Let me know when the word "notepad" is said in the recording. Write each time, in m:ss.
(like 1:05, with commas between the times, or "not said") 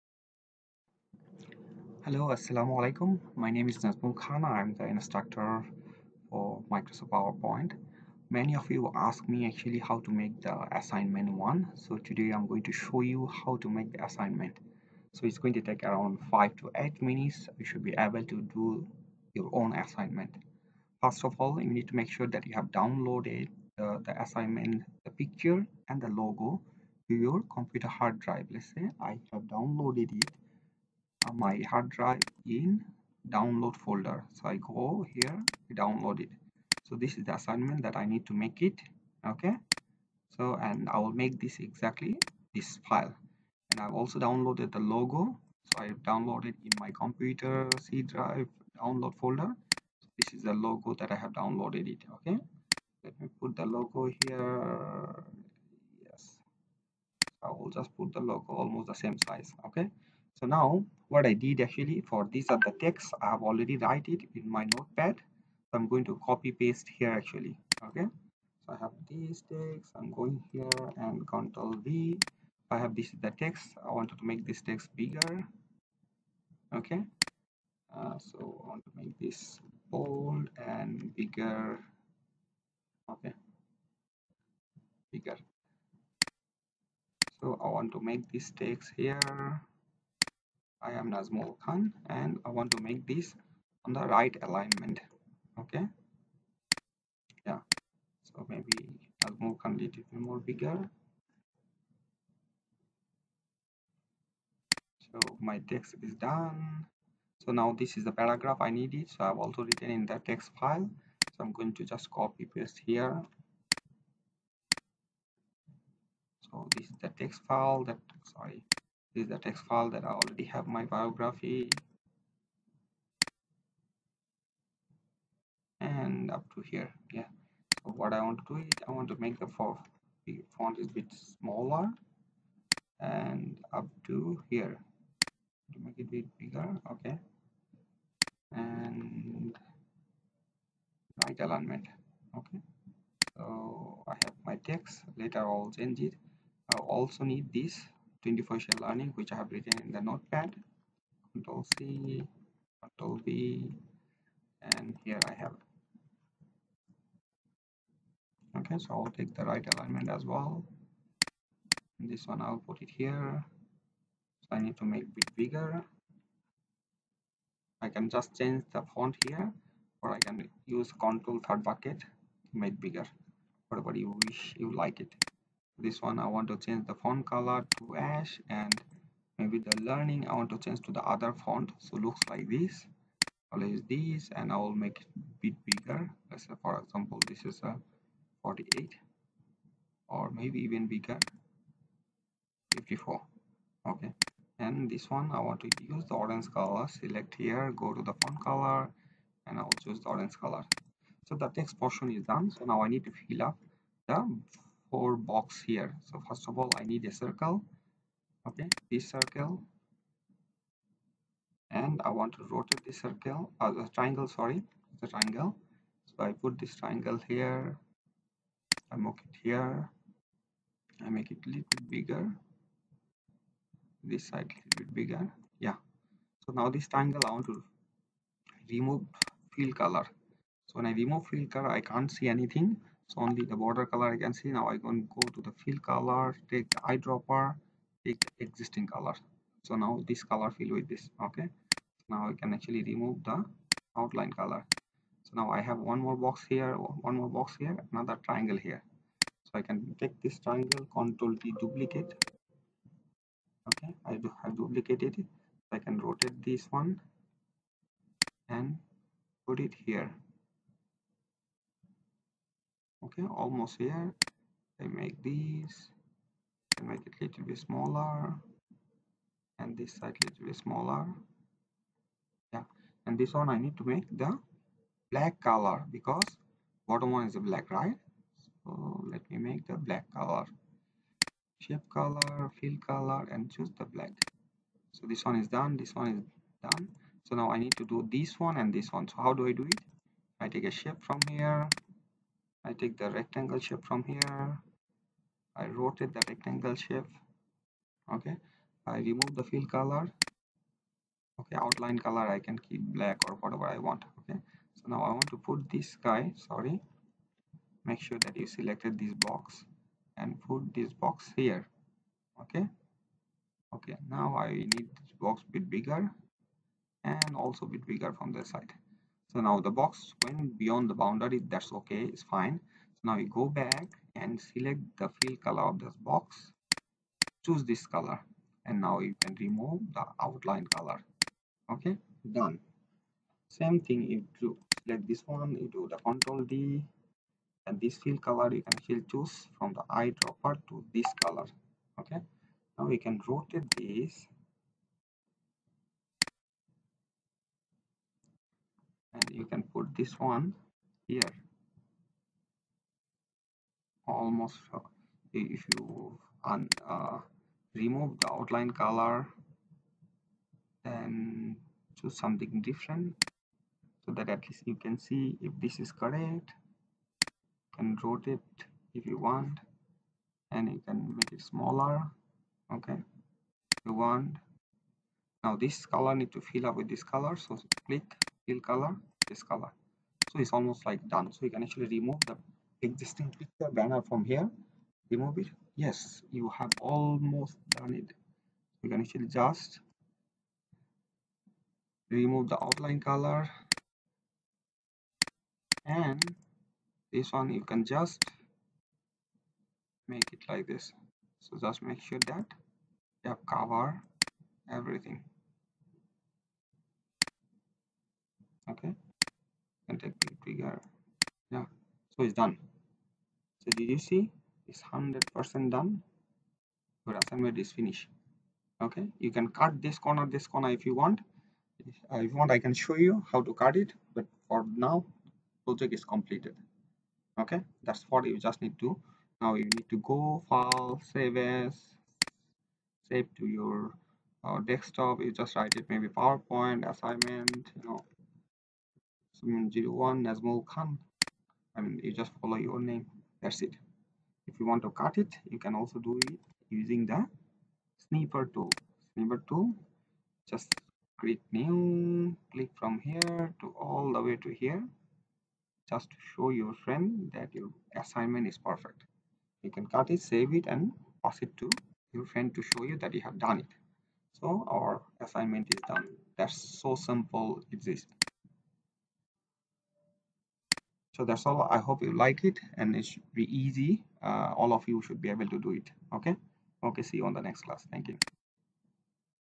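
1:04, 2:30.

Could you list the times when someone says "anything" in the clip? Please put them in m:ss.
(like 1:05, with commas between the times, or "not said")
3:52.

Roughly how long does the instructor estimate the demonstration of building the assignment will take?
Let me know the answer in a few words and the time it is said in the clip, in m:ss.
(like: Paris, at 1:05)
5 to 8 minutes, at 0:16.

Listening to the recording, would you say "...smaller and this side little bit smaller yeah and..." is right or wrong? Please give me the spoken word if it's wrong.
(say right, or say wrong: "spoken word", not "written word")
right.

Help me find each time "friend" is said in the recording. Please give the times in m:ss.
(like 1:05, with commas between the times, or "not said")
7:36, 7:42.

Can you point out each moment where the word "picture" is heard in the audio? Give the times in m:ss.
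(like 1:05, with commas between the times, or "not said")
0:25, 6:23.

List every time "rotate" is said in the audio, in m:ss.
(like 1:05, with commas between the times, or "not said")
3:32, 4:15, 4:55, 5:43, 6:08.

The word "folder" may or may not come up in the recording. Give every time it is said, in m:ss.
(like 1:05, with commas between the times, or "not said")
0:33, 0:49.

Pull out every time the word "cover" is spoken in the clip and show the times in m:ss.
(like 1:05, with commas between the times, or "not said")
6:43.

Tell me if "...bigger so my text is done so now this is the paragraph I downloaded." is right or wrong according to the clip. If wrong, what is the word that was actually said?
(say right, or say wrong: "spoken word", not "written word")
wrong: "needed", not "downloaded".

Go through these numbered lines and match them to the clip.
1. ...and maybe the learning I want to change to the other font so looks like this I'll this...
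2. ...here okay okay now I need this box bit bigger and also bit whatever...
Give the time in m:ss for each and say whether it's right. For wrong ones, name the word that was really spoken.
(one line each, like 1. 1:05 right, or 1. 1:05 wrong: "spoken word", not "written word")
1. 2:58 right
2. 5:11 wrong: "bigger", not "whatever".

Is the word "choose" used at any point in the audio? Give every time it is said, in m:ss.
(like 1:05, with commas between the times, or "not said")
3:19, 4:43, 5:27, 5:39, 6:01.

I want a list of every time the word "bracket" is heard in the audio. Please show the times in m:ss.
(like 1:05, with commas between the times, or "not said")
2:51.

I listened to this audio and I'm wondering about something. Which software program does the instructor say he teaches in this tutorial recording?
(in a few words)
Microsoft PowerPoint.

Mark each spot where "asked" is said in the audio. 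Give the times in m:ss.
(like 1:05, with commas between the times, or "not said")
0:08.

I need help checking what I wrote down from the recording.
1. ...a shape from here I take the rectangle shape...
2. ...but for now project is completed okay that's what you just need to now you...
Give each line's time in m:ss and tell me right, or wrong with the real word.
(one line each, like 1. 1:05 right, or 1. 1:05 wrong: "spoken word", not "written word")
1. 4:50 right
2. 7:04 right.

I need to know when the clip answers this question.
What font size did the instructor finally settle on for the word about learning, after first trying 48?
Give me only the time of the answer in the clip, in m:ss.
3:12.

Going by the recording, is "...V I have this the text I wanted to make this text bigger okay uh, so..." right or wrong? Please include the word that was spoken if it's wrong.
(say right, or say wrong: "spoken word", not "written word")
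right.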